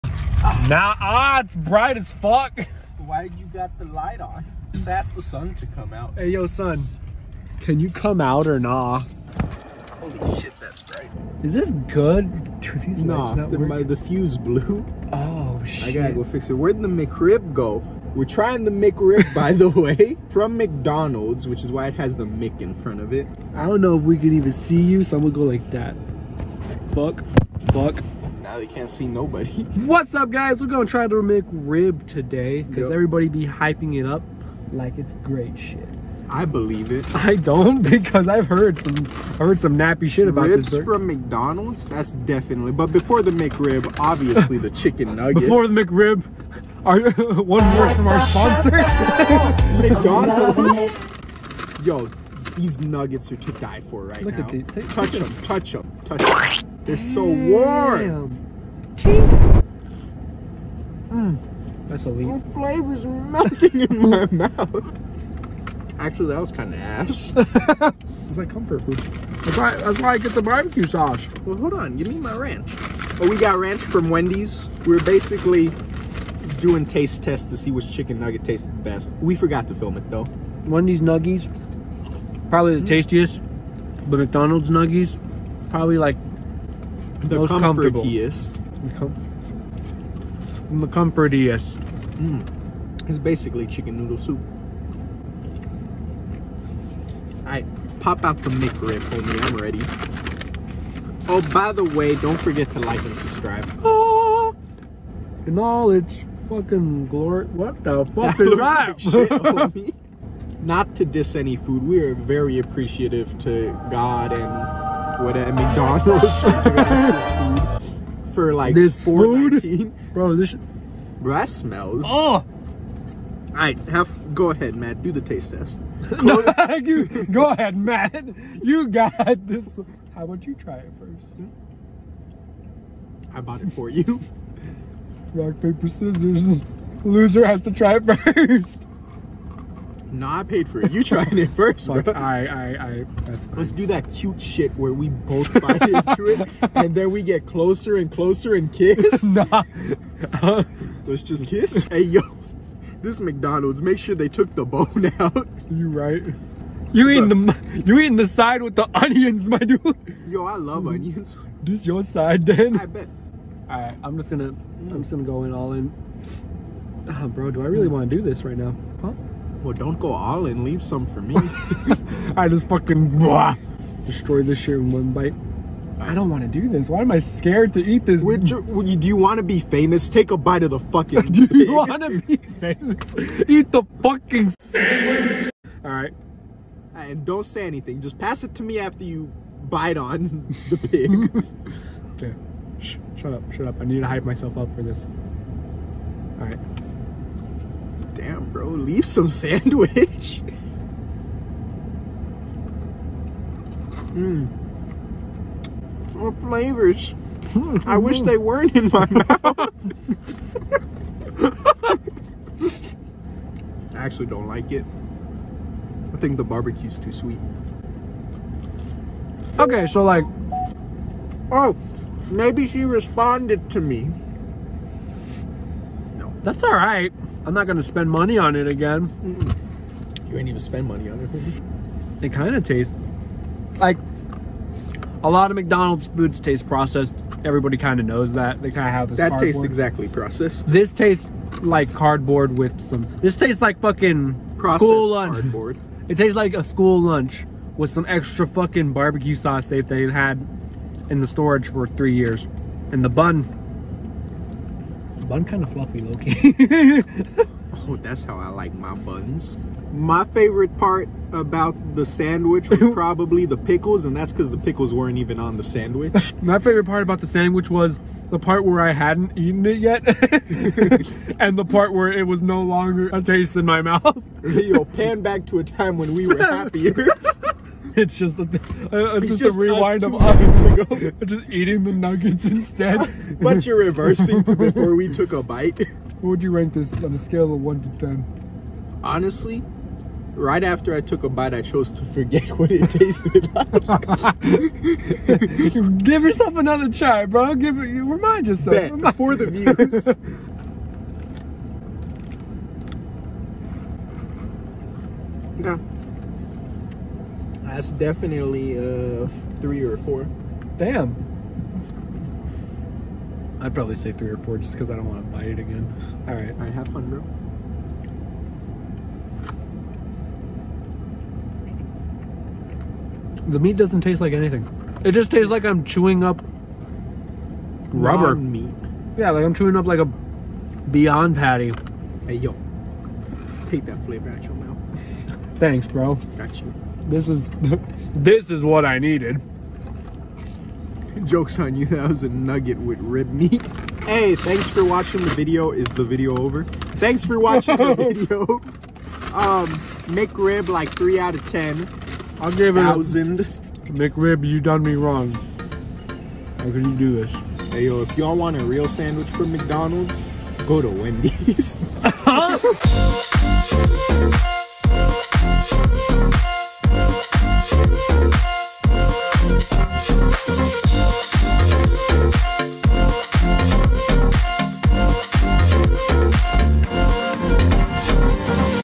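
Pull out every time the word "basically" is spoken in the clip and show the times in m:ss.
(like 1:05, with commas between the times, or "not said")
1:15, 1:33.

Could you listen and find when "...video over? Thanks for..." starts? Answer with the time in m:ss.
5:46.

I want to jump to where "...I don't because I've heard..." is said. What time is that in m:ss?
0:37.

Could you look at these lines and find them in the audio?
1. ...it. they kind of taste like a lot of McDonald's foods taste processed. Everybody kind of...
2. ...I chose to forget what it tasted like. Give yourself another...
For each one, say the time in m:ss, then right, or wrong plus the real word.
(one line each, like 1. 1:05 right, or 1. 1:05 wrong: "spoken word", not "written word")
1. 3:51 right
2. 4:51 right.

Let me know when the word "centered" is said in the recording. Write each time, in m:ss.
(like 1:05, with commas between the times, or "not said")
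not said.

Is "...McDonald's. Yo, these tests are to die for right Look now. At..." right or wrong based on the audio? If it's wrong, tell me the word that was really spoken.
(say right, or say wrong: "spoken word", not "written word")
wrong: "nuggets", not "tests".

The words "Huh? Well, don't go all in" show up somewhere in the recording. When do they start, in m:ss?
2:49.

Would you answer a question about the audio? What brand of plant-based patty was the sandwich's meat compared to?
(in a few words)
Beyond.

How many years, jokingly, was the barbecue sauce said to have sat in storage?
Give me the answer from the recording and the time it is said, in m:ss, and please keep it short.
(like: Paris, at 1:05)
3, at 4:11.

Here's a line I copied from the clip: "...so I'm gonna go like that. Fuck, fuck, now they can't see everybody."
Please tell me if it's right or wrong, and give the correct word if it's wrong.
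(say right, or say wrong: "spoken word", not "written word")
wrong: "nobody", not "everybody".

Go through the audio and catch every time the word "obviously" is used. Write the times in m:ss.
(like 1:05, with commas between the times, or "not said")
0:43.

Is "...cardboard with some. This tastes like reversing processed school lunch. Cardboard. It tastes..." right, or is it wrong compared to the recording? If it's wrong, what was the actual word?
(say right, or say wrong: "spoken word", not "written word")
wrong: "fucking", not "reversing".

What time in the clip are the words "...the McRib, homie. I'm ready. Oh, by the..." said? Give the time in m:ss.
1:38.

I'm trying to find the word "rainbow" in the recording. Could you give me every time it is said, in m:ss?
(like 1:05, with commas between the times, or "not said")
not said.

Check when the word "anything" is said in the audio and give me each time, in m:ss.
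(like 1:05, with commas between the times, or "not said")
3:07, 5:24.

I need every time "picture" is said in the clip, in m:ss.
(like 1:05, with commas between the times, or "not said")
not said.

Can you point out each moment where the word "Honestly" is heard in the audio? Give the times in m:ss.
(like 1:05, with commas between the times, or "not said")
4:49.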